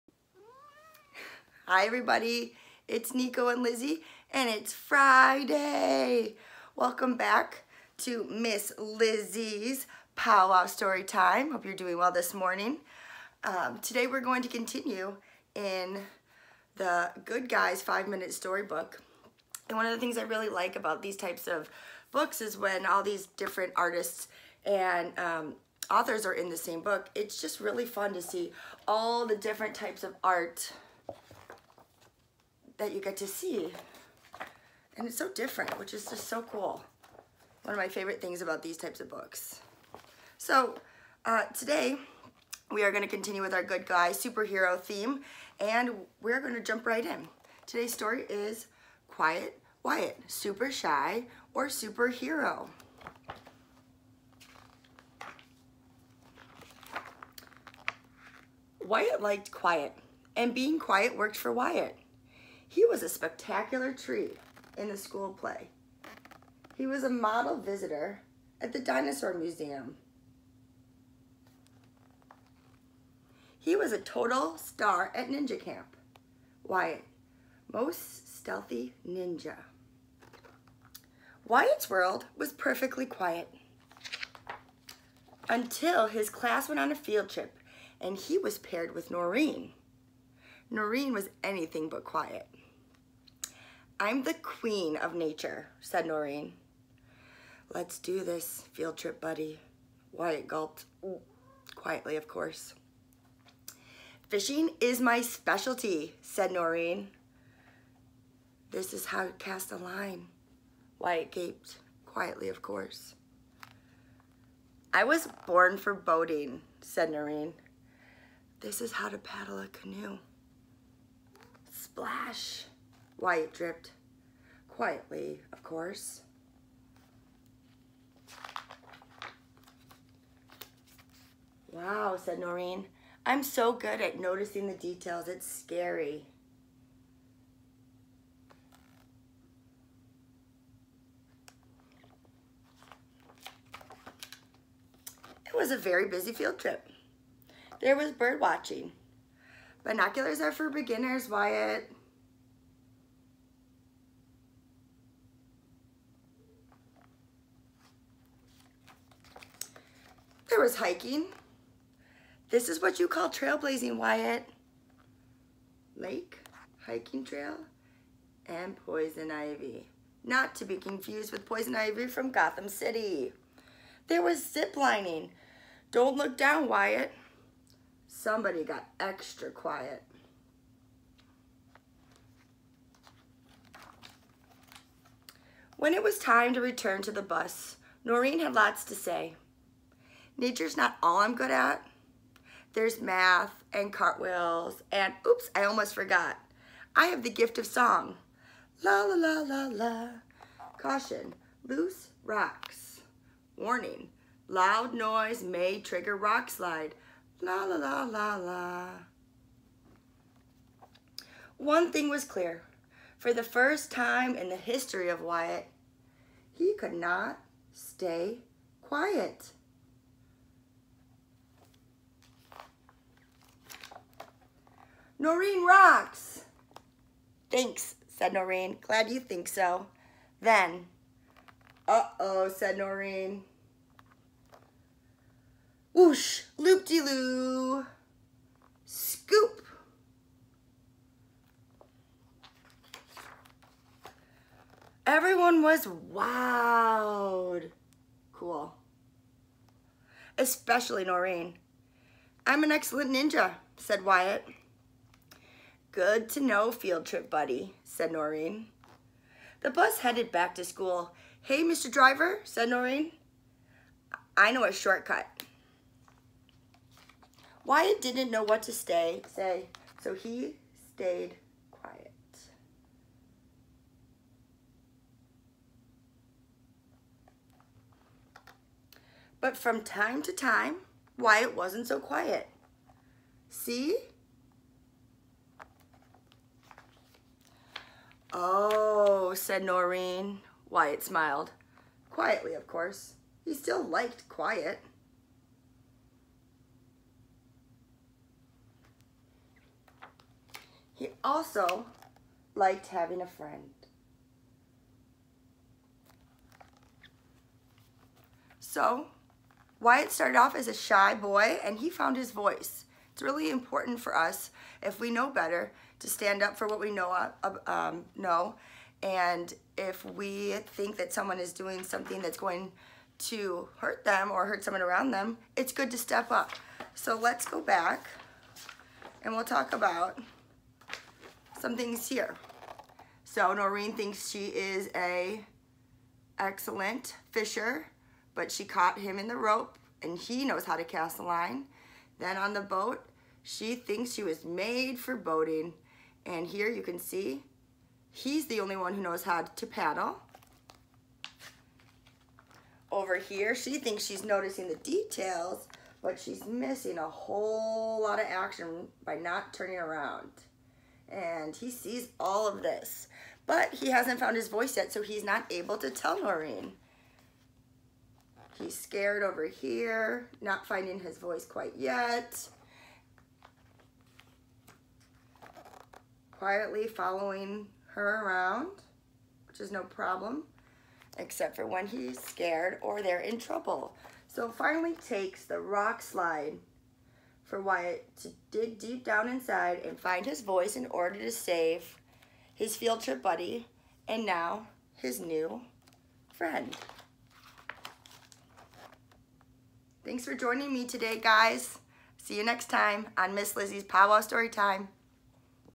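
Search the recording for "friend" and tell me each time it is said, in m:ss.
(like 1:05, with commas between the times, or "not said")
5:03, 6:36.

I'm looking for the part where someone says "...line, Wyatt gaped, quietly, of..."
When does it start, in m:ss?
1:49.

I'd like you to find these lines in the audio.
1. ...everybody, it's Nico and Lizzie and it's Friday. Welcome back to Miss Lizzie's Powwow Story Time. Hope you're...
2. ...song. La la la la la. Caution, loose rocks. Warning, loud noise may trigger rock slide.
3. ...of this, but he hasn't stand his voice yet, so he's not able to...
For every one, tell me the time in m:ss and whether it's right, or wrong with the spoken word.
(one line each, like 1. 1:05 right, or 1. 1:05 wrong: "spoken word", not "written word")
1. 0:01 right
2. 3:17 right
3. 6:02 wrong: "found", not "stand".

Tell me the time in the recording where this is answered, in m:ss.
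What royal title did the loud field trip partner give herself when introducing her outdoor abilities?
1:34.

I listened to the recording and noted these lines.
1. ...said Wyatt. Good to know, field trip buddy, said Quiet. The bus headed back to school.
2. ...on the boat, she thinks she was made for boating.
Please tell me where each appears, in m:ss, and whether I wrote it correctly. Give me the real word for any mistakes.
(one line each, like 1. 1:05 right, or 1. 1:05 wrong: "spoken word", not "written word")
1. 4:13 wrong: "Noreen", not "Quiet"
2. 5:42 right.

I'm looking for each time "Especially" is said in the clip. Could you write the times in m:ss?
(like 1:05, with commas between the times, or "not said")
4:10.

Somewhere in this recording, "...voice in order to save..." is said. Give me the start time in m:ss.
6:30.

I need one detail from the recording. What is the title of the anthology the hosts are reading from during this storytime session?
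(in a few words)
Good Guys 5 Minute Storybook.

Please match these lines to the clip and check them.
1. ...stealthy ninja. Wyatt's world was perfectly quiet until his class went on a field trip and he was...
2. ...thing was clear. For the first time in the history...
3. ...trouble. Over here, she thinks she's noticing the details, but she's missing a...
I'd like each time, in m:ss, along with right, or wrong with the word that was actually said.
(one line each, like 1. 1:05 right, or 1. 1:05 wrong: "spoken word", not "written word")
1. 1:18 right
2. 3:31 right
3. 5:49 wrong: "paddle", not "trouble".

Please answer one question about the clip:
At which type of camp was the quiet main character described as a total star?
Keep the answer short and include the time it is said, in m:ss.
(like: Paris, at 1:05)
Ninja Camp, at 1:15.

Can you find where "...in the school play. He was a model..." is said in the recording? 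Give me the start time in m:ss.
1:04.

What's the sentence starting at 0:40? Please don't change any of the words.
So uh, today, we are gonna continue with our good guy superhero theme, and we're gonna jump right in.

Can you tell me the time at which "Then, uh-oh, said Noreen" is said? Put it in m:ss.
3:50.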